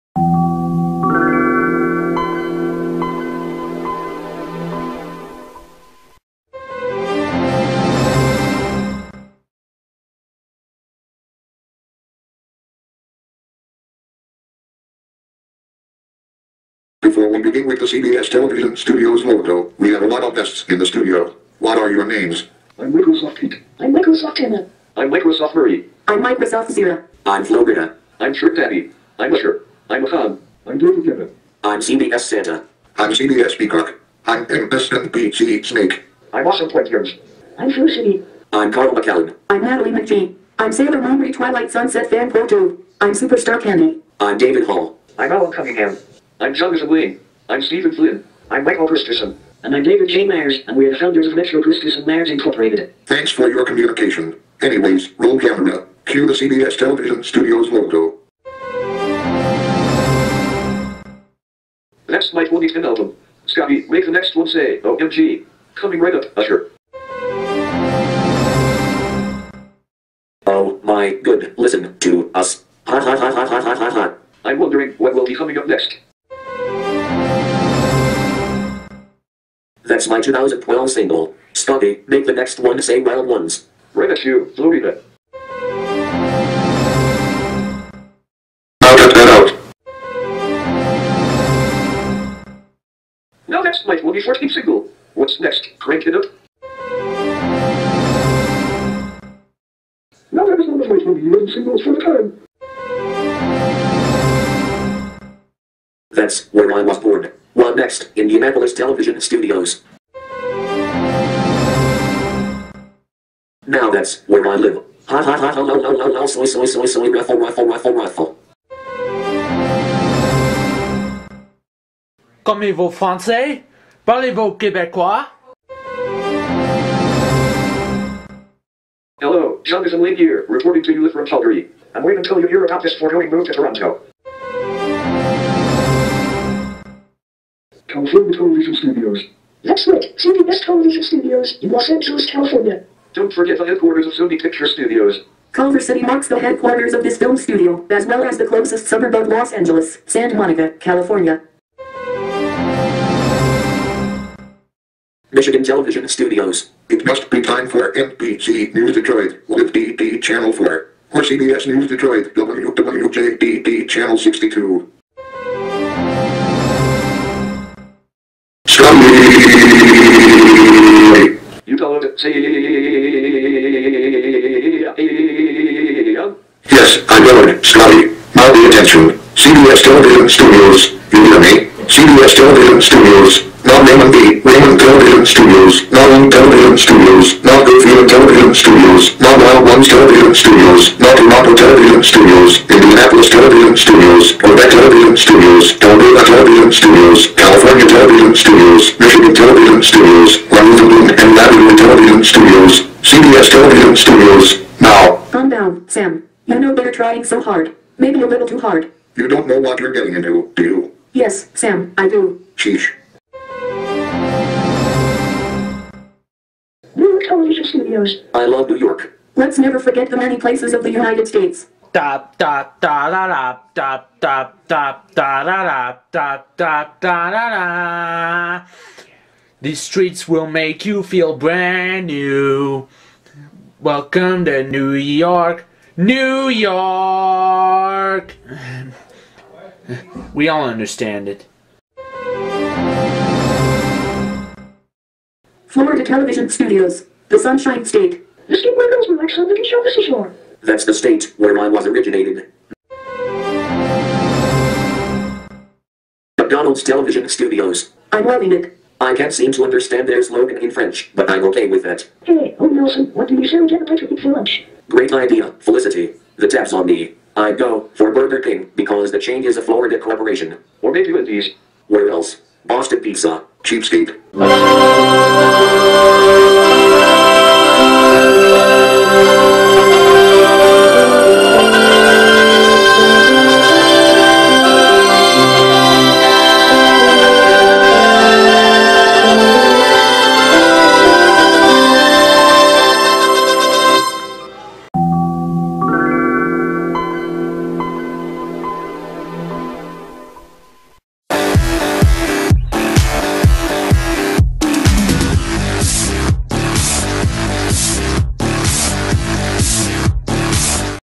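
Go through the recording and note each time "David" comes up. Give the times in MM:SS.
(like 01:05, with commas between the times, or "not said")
00:30, 00:44, 00:49.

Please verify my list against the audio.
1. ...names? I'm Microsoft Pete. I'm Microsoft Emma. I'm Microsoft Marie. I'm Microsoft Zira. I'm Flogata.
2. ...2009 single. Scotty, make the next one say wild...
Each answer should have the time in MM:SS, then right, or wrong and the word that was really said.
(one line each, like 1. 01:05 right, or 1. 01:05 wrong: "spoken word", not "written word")
1. 00:22 right
2. 01:20 wrong: "2012", not "2009".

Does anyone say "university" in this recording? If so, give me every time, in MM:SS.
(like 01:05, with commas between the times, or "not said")
not said.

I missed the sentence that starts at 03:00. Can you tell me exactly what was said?
Studios, Udemy, CBS Television Studios, not Raymond B.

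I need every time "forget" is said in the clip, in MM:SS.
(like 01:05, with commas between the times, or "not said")
02:23, 03:39.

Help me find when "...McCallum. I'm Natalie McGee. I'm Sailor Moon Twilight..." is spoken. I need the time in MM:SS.
00:38.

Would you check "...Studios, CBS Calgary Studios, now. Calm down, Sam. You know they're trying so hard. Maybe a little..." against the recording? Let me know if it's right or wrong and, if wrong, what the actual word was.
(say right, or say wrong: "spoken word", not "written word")
wrong: "Television", not "Calgary".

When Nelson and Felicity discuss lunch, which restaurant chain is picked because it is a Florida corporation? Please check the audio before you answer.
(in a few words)
Burger King.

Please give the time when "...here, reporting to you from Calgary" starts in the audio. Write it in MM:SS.
02:10.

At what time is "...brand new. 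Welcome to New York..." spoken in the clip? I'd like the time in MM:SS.
03:51.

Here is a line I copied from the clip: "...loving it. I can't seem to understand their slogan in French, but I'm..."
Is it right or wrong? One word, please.
right.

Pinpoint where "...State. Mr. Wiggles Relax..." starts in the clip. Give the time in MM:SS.
04:07.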